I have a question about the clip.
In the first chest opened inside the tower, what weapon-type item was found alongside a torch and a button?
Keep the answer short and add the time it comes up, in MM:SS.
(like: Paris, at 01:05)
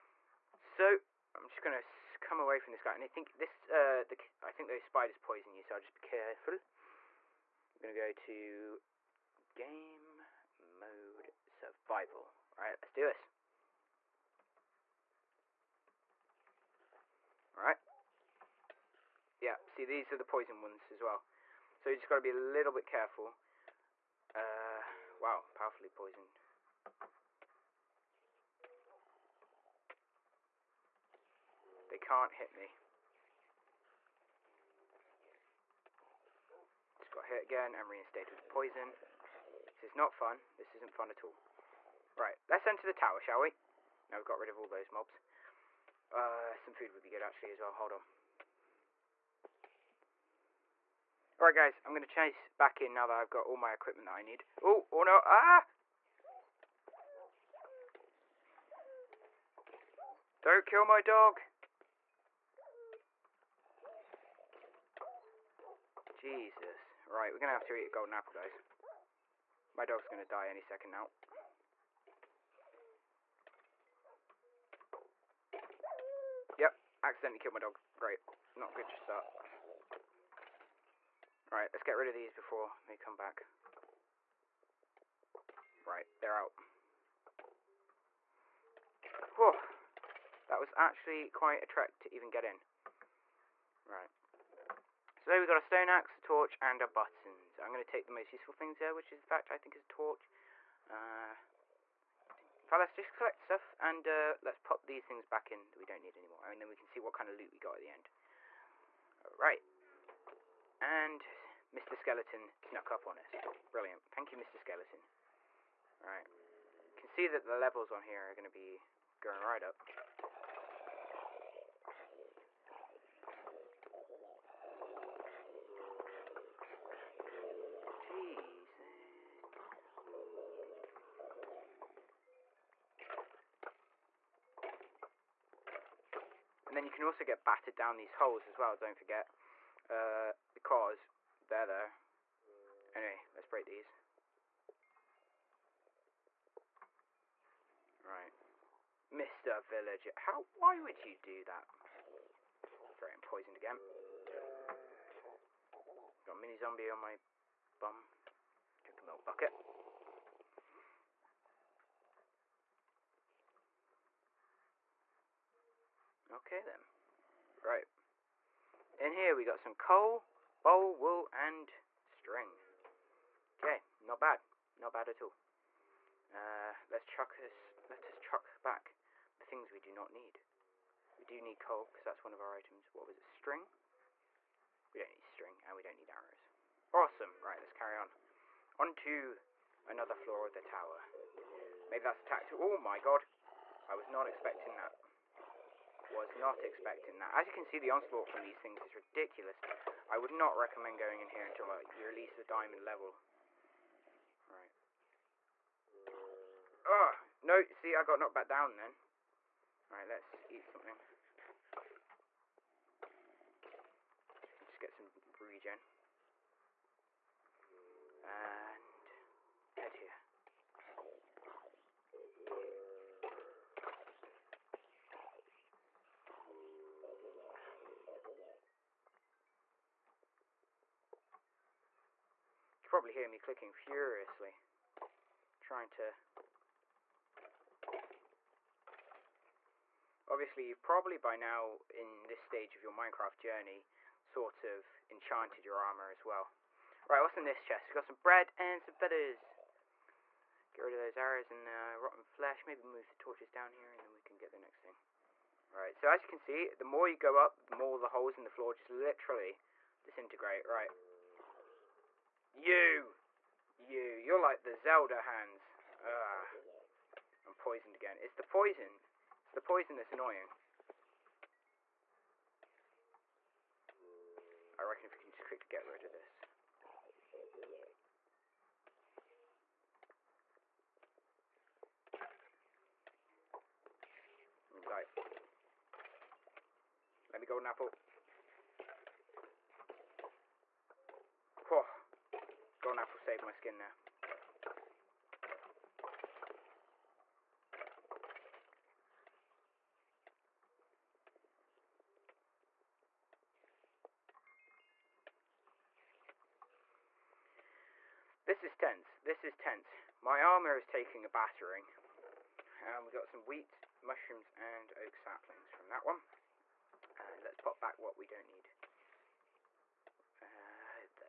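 Stone axe, at 01:35.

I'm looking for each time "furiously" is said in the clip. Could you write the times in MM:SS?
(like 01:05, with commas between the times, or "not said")
03:53.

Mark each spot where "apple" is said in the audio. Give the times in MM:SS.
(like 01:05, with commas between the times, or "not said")
01:08, 04:47, 04:52.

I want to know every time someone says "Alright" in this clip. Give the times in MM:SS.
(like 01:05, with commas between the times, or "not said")
00:51, 01:49, 01:56, 03:29.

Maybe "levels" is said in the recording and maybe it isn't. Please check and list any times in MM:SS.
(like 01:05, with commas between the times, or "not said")
01:57, 03:22.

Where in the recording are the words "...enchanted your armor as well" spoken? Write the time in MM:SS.
04:05.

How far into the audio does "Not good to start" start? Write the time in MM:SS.
01:18.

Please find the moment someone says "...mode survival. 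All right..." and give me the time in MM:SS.
00:10.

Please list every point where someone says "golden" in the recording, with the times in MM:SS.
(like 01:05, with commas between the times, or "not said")
01:07, 04:47, 04:52.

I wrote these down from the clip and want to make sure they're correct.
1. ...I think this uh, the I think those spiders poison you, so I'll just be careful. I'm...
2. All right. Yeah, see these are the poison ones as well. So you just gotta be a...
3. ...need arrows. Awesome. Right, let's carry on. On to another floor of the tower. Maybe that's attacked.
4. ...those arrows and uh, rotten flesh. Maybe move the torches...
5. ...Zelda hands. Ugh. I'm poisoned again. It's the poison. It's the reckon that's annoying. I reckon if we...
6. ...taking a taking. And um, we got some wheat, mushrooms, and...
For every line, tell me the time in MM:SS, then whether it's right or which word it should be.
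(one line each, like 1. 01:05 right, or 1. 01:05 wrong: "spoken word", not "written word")
1. 00:03 right
2. 00:17 right
3. 03:05 right
4. 04:10 right
5. 04:24 wrong: "poison", not "reckon"
6. 05:10 wrong: "battering", not "taking".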